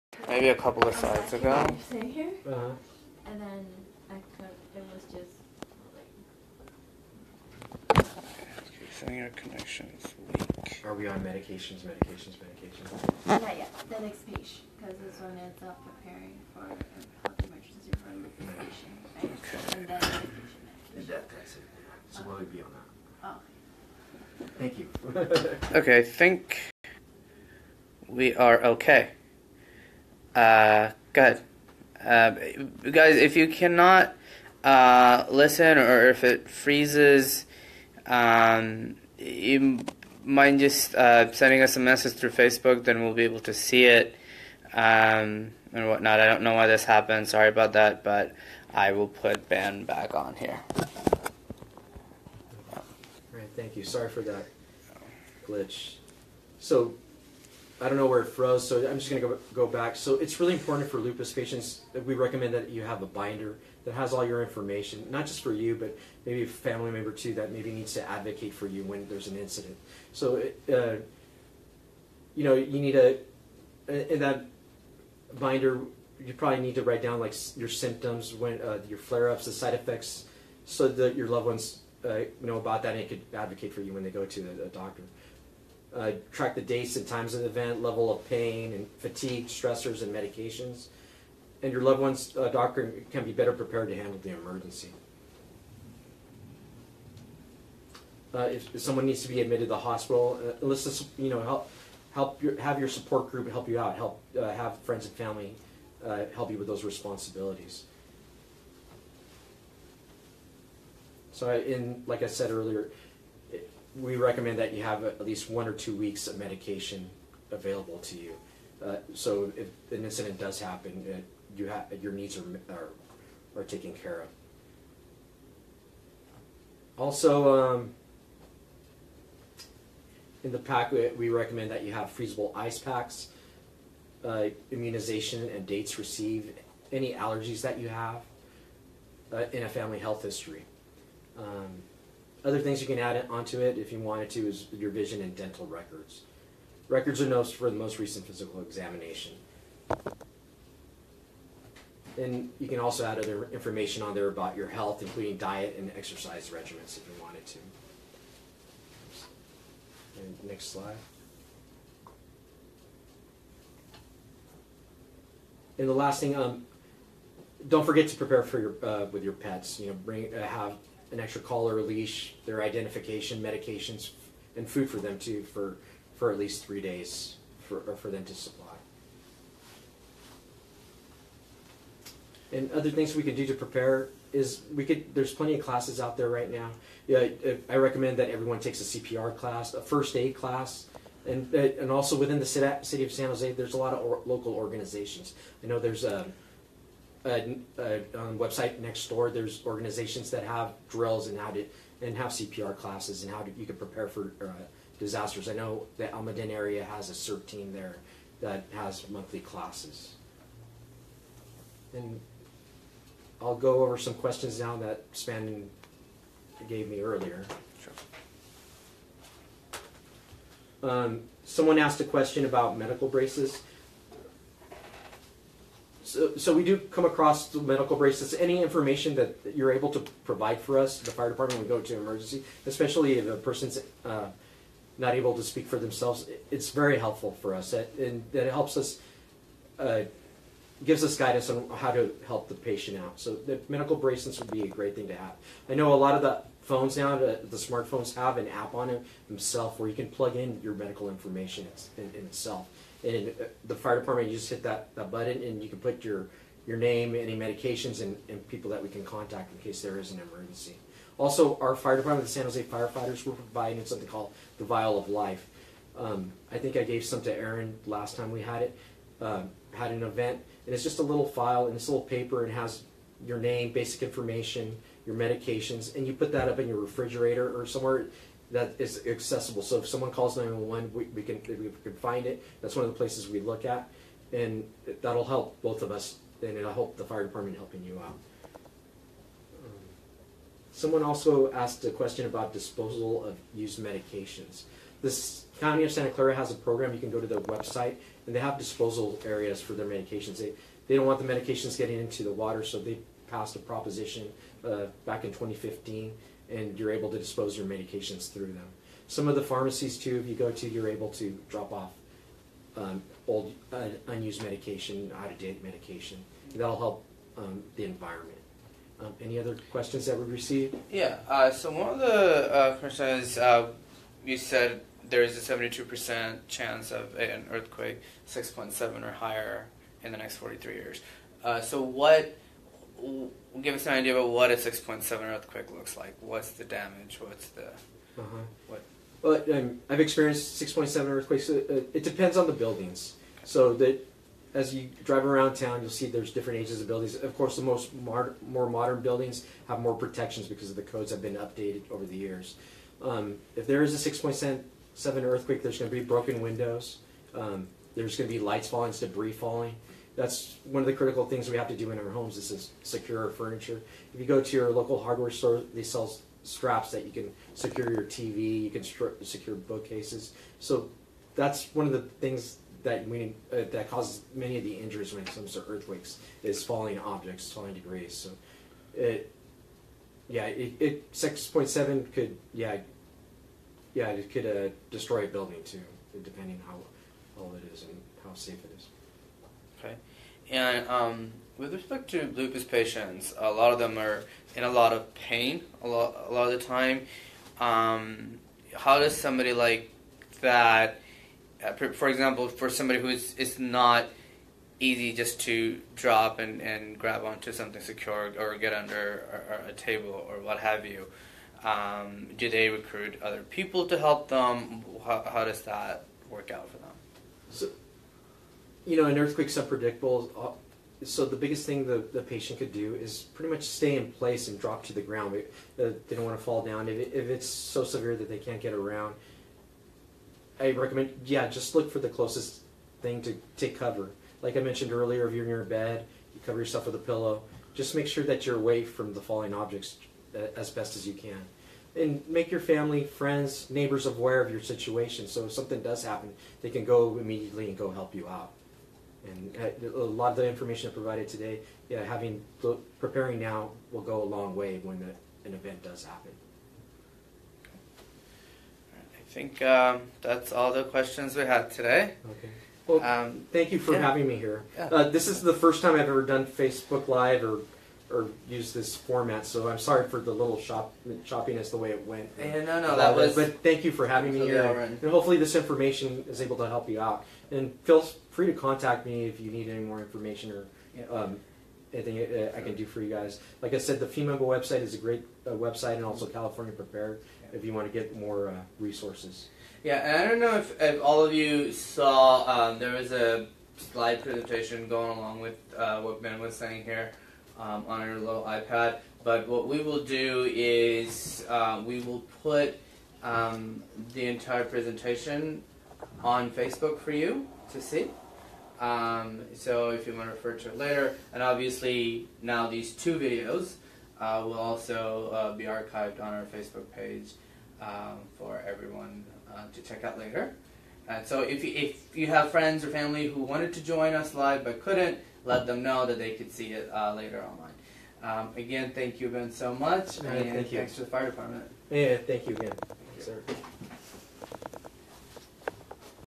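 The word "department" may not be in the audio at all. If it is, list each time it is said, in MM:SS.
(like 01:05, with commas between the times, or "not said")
03:51, 04:13, 04:21, 04:47, 08:51.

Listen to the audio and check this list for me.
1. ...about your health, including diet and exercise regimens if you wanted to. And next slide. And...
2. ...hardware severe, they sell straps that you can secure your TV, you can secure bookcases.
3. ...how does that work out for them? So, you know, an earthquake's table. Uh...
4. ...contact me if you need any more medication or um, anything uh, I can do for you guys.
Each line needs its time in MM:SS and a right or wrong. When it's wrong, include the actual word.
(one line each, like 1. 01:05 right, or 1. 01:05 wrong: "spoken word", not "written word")
1. 02:34 right
2. 06:05 wrong: "store", not "severe"
3. 06:55 wrong: "unpredictable", not "table"
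4. 07:58 wrong: "information", not "medication".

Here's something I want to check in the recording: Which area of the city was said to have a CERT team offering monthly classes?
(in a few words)
Almaden.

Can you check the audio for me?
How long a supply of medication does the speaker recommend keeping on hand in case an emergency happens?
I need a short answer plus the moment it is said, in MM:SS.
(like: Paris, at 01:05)
one or two weeks, at 01:55.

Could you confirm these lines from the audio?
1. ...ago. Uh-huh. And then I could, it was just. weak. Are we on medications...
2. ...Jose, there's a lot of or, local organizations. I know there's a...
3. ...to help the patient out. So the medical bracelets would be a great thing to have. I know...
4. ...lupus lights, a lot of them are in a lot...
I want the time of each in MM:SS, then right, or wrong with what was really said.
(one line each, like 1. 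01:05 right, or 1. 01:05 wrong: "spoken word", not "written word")
1. 00:01 right
2. 03:13 right
3. 04:01 right
4. 06:32 wrong: "patients", not "lights".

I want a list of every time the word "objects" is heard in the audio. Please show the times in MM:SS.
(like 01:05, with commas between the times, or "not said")
06:16, 07:19.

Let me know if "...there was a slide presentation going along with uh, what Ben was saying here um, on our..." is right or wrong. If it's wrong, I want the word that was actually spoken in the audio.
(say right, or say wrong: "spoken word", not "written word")
right.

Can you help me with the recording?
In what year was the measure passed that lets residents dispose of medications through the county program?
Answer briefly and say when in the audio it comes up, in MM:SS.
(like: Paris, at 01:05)
2015, at 05:05.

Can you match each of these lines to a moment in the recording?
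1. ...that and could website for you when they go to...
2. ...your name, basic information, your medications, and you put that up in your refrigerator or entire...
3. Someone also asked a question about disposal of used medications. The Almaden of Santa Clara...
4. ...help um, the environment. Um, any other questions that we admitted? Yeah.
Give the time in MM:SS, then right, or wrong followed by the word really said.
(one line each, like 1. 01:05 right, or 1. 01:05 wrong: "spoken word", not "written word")
1. 01:22 wrong: "advocate", not "website"
2. 04:33 wrong: "somewhere", not "entire"
3. 04:50 wrong: "County", not "Almaden"
4. 05:16 wrong: "received", not "admitted".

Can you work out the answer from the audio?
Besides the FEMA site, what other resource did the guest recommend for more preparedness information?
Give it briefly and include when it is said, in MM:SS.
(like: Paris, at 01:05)
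California Prepared, at 08:06.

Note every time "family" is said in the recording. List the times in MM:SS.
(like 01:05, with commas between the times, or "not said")
01:06, 01:45, 02:19, 07:22, 08:42.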